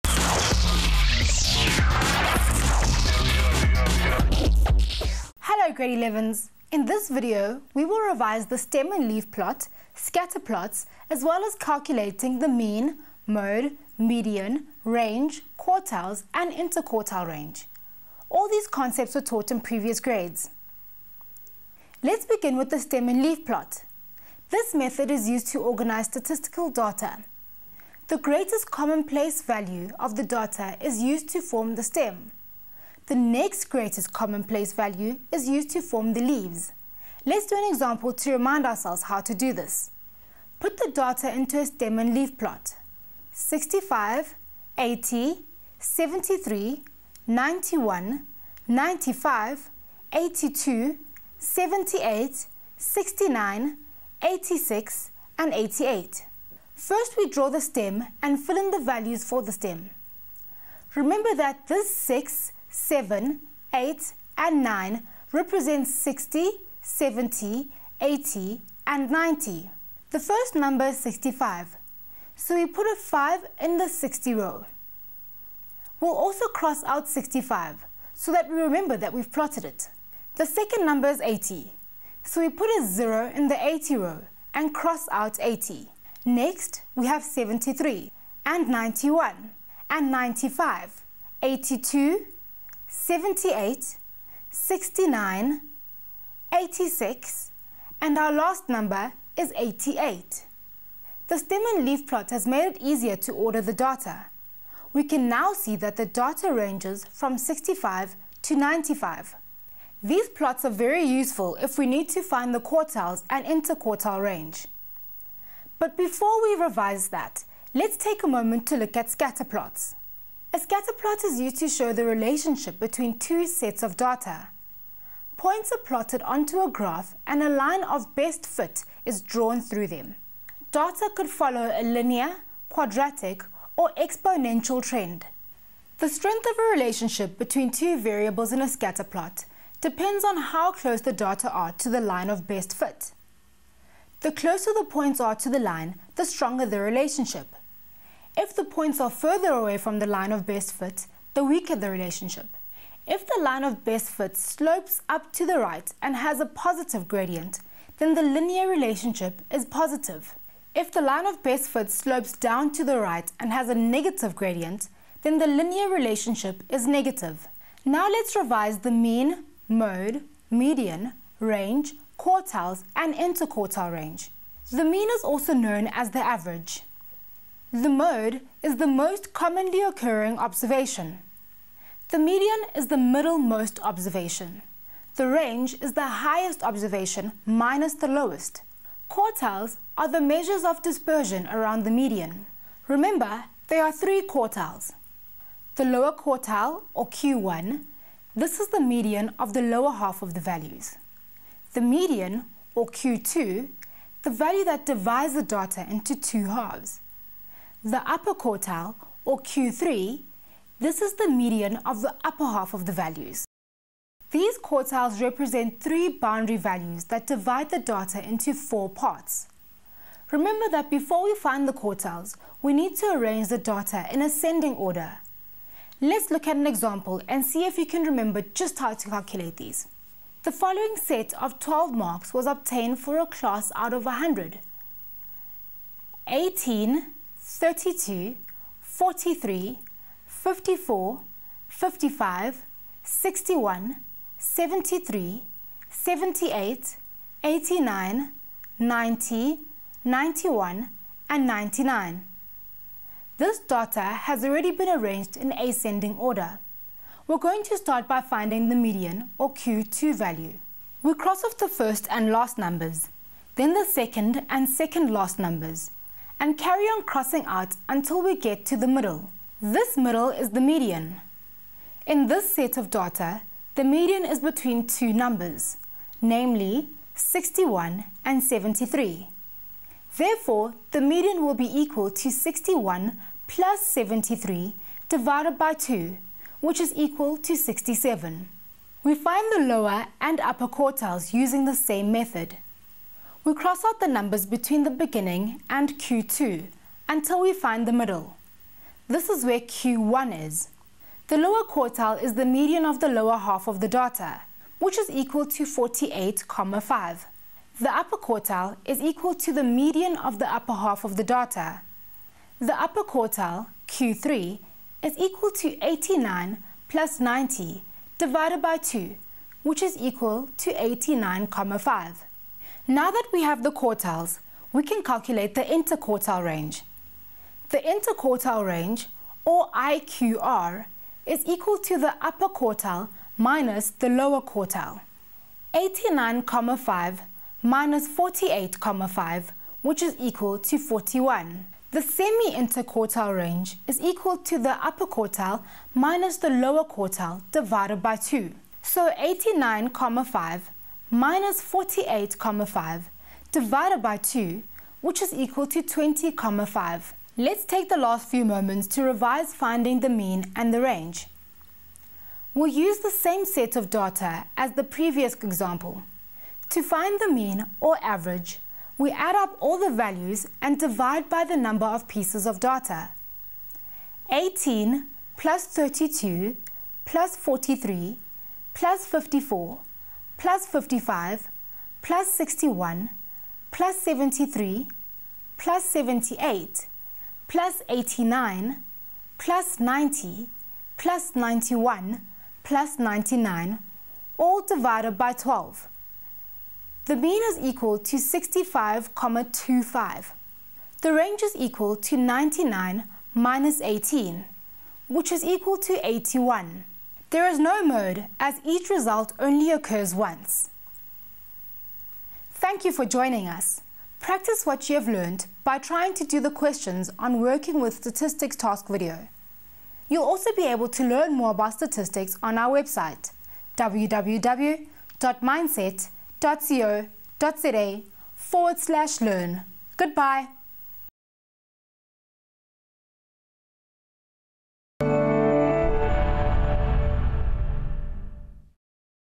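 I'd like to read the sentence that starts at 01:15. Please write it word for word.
We'll also cross out 65 so that we remember that we've plotted it.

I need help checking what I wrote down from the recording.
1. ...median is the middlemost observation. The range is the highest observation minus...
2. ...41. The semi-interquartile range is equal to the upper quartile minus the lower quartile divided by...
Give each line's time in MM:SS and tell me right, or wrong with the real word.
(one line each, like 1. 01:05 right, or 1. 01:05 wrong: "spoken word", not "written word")
1. 03:02 right
2. 05:40 right.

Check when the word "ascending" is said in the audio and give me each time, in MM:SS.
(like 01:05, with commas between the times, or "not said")
03:44, 04:15.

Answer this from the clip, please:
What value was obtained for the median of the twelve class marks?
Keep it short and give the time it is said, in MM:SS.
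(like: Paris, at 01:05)
67, at 04:47.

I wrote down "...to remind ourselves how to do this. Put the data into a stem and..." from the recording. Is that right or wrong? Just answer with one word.
right.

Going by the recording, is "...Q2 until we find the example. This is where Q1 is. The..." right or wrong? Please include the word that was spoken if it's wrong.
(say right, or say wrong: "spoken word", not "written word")
wrong: "middle", not "example".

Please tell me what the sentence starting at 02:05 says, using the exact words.
Points are plotted onto a graph and a line of best fit is drawn through them.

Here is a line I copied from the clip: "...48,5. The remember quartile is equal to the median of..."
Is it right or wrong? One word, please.
wrong.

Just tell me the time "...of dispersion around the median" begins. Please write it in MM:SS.
03:10.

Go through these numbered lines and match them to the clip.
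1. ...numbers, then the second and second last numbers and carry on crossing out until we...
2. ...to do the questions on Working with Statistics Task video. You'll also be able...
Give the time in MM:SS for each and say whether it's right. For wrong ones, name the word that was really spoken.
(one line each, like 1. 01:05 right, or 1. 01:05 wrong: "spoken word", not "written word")
1. 04:22 right
2. 06:56 right.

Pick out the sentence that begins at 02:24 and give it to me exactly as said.
The closer the points are to the line, the stronger the relationship.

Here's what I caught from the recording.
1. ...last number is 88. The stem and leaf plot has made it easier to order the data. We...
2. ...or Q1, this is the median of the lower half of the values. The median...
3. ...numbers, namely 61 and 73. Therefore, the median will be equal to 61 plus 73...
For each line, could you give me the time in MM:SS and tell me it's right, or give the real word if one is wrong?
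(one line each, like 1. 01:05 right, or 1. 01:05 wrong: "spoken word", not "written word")
1. 01:38 right
2. 03:16 right
3. 04:35 right.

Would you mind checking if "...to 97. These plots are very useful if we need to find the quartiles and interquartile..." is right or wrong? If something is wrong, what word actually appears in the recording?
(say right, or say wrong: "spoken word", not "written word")
wrong: "95", not "97".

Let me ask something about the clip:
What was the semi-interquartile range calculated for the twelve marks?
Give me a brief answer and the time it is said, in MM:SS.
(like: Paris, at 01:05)
20,5, at 05:55.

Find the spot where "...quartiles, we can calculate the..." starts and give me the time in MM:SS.
05:23.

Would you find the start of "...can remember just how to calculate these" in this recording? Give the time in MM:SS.
03:47.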